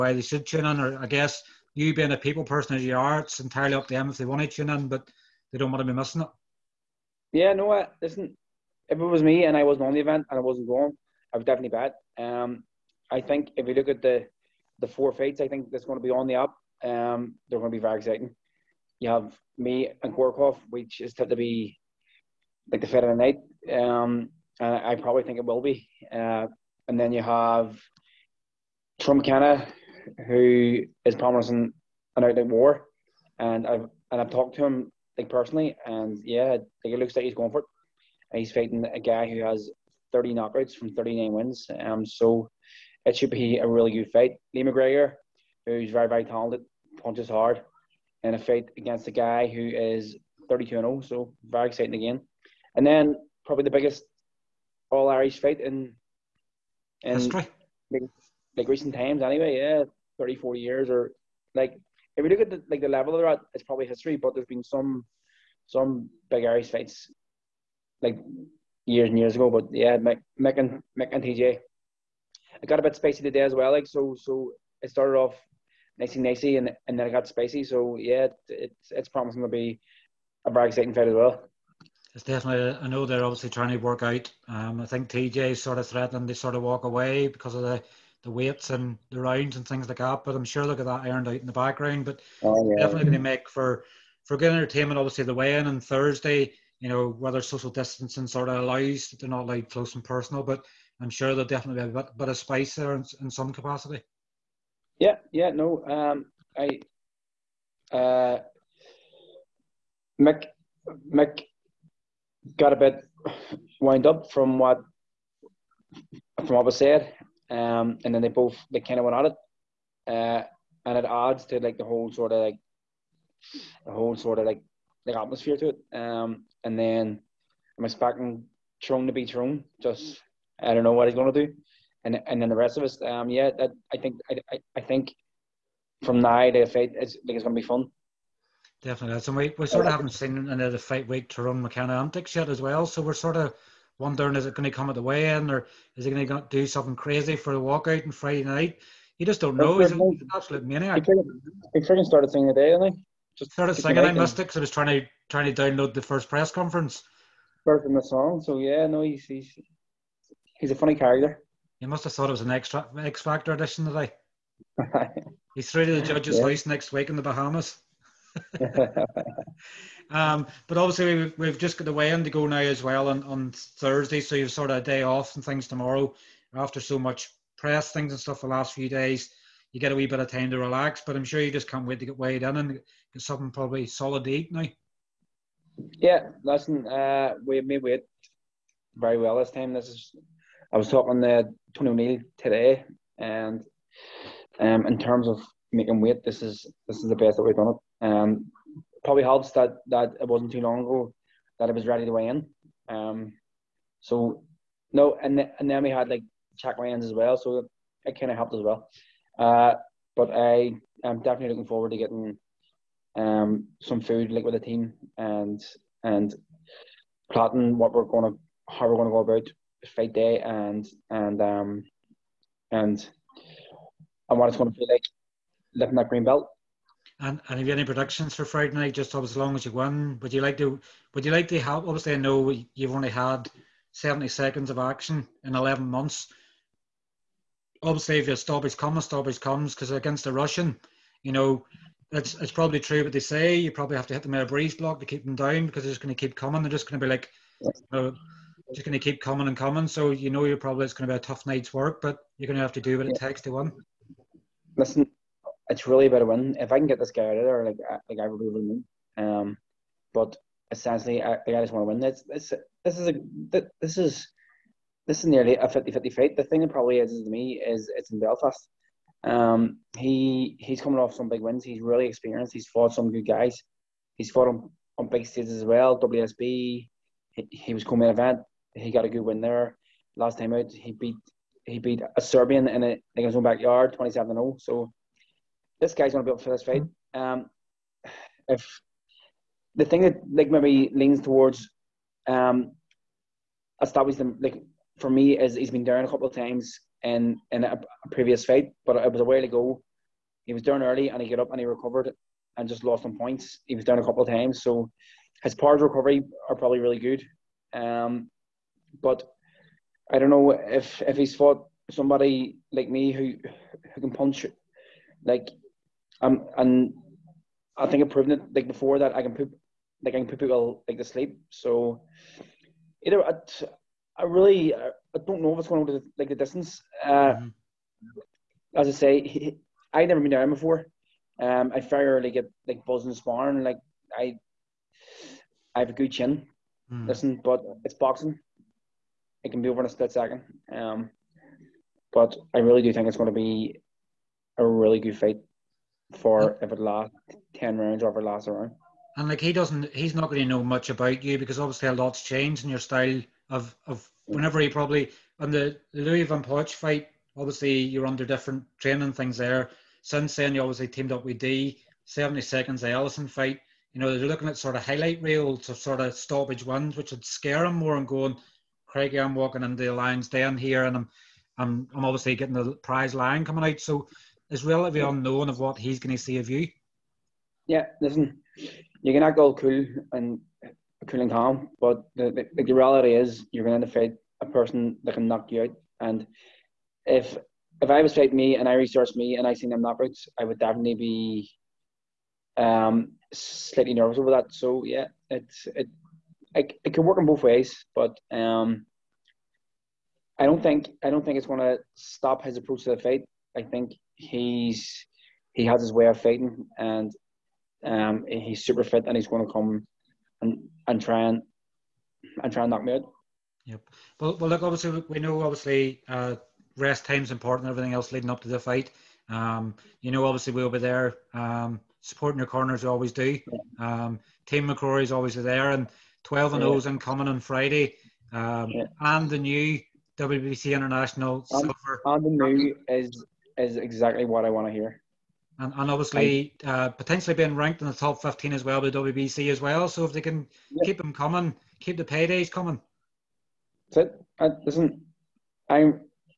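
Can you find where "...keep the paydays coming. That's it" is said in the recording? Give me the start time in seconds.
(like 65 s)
441 s.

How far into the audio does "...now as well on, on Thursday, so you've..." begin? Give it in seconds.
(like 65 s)
172 s.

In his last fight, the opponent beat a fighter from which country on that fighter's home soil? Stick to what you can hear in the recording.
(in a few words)
Serbian.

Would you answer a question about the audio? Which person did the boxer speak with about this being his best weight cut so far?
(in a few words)
Tony O'Neill.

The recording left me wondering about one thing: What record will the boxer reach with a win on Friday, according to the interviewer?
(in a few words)
12 and 0.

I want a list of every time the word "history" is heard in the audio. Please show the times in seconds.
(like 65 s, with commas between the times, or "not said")
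57 s, 63 s.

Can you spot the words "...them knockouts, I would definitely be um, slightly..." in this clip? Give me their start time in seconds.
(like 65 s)
389 s.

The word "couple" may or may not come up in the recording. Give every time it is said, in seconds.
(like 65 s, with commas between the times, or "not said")
296 s, 304 s.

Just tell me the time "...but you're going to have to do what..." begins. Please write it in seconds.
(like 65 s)
252 s.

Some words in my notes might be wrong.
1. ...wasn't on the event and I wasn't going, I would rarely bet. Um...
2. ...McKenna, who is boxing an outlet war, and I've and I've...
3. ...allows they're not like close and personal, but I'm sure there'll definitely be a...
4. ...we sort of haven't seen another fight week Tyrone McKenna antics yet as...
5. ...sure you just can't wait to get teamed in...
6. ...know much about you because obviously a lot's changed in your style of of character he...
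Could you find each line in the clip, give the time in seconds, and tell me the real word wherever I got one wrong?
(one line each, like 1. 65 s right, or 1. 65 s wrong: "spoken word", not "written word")
1. 9 s wrong: "definitely", not "rarely"
2. 29 s wrong: "promising", not "boxing"
3. 98 s right
4. 139 s right
5. 181 s wrong: "weighed", not "teamed"
6. 350 s wrong: "whenever", not "character".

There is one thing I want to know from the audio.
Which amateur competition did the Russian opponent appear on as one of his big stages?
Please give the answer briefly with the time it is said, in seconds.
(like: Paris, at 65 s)
WSB, at 275 s.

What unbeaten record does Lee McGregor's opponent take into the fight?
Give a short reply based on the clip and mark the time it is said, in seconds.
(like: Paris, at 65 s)
32 and 0, at 50 s.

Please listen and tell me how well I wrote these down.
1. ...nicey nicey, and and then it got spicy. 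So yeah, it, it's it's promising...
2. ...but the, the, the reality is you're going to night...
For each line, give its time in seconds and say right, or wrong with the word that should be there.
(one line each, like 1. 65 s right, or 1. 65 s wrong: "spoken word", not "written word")
1. 75 s right
2. 381 s wrong: "fight", not "night".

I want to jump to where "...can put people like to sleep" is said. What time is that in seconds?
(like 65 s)
320 s.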